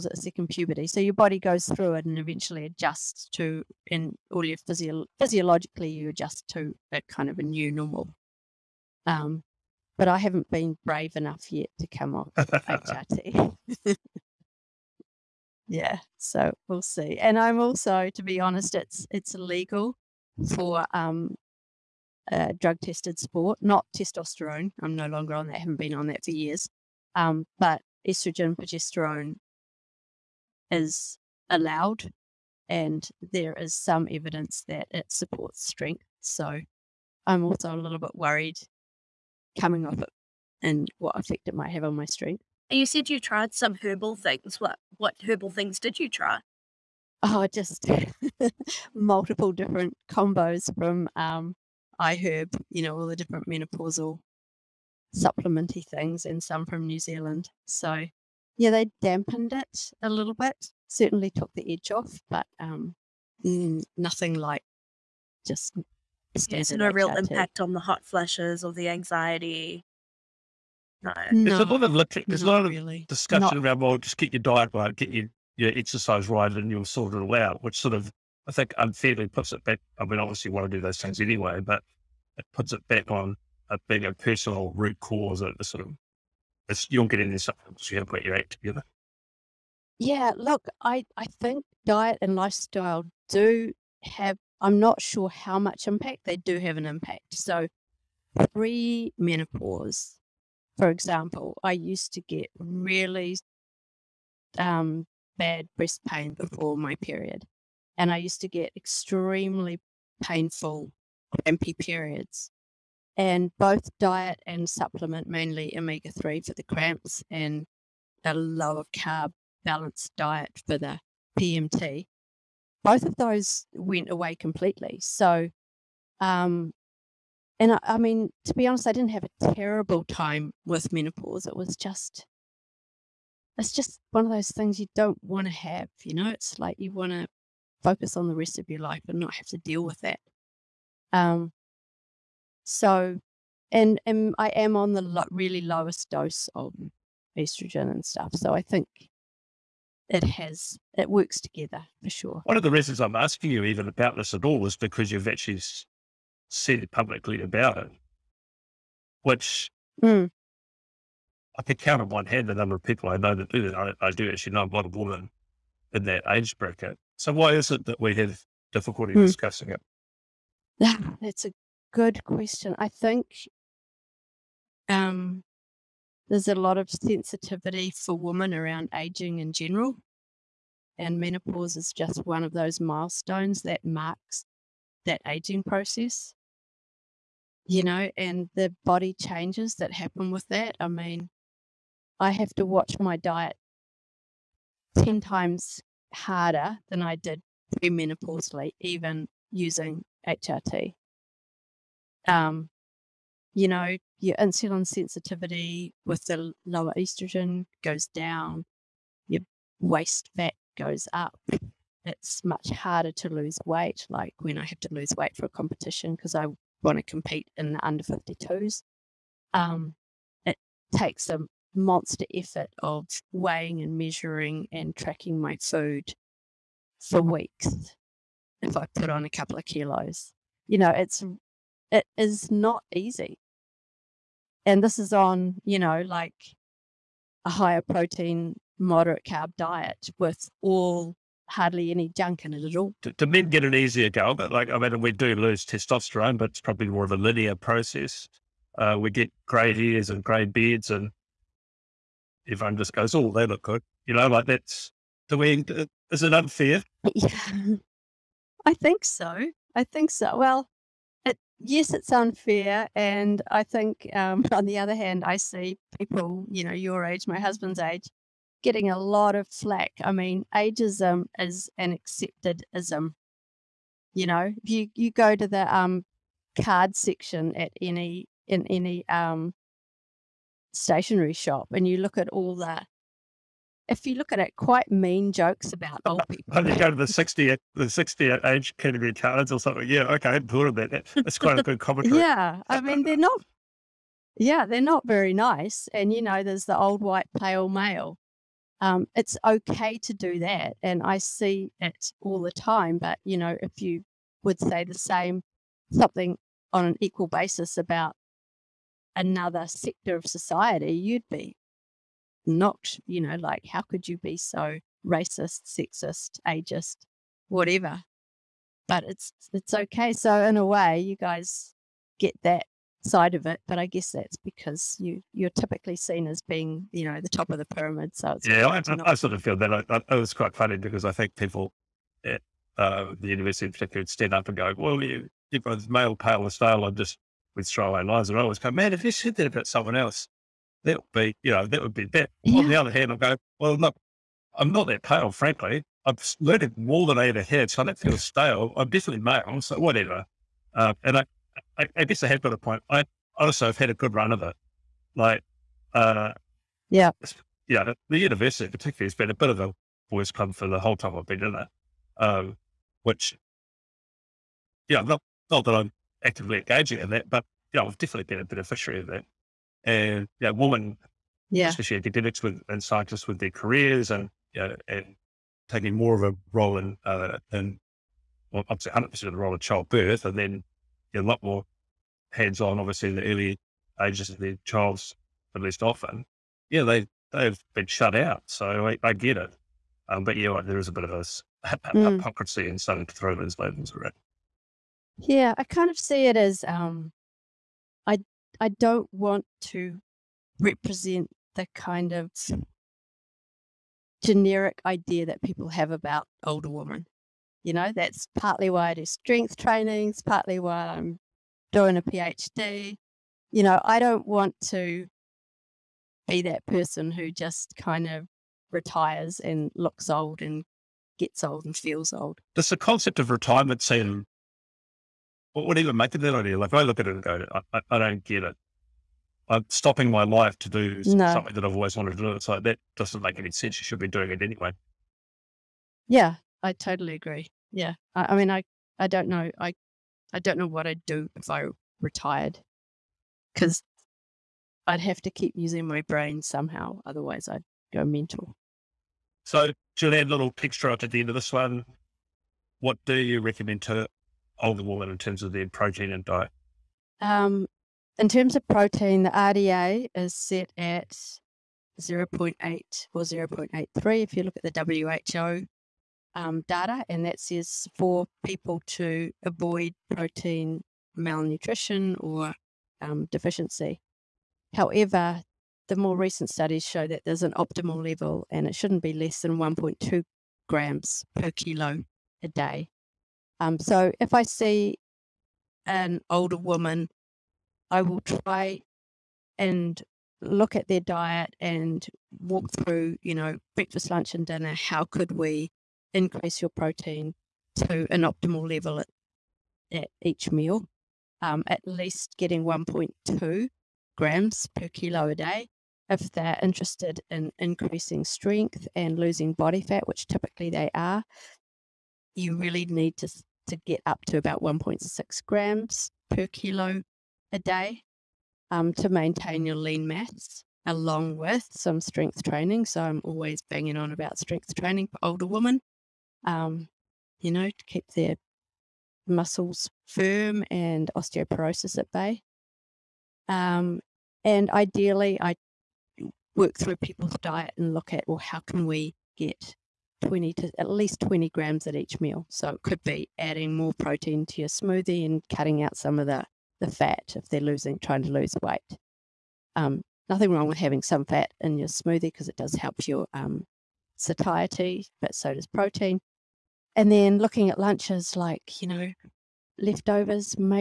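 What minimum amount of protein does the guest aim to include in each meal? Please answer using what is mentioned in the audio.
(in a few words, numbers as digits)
20 grams.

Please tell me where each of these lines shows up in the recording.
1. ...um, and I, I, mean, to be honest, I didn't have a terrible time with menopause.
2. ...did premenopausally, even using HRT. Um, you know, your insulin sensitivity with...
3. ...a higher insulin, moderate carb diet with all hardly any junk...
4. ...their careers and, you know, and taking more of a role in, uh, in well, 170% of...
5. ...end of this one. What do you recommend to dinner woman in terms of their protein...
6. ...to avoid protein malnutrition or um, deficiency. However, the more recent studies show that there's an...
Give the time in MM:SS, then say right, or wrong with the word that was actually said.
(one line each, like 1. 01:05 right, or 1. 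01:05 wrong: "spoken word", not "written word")
1. 02:06 right
2. 03:17 right
3. 03:57 wrong: "protein", not "insulin"
4. 06:13 wrong: "100", not "170"
5. 07:31 wrong: "older", not "dinner"
6. 07:48 right.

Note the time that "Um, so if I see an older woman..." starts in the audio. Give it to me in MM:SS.
08:03.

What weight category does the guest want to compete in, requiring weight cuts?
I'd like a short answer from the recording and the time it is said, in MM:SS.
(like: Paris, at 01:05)
under 52s, at 03:37.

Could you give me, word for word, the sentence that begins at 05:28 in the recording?
So yeah, I, I, I, sort of feel that.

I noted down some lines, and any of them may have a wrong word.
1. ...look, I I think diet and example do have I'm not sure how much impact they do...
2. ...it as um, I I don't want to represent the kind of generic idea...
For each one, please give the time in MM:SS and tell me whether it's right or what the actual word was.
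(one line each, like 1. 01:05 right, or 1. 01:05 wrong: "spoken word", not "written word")
1. 01:30 wrong: "lifestyle", not "example"
2. 06:36 right.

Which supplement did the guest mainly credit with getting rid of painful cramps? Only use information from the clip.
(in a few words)
omega 3.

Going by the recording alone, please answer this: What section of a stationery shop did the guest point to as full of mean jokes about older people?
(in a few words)
card section.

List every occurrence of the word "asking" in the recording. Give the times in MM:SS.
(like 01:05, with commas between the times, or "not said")
02:33.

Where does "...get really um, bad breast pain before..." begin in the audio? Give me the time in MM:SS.
01:42.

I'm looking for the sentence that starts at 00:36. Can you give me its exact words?
So I'm also a little bit worried coming off it and what effect it might have on my strength.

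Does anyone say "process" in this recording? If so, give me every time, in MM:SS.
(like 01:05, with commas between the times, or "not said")
03:05, 04:07.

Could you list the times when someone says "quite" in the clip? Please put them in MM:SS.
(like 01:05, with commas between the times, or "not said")
04:44, 04:51, 05:30.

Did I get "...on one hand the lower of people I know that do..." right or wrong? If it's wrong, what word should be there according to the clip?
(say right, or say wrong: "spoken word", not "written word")
wrong: "number", not "lower".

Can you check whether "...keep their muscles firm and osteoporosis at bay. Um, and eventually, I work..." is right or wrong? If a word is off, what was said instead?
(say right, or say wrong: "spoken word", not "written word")
wrong: "ideally", not "eventually".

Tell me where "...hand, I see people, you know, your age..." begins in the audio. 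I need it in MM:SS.
04:24.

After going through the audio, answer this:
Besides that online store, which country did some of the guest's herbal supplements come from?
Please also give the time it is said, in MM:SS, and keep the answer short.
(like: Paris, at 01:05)
New Zealand, at 00:56.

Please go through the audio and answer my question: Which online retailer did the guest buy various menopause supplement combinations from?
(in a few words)
iHerb.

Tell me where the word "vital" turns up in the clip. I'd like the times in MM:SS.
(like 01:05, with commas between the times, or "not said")
not said.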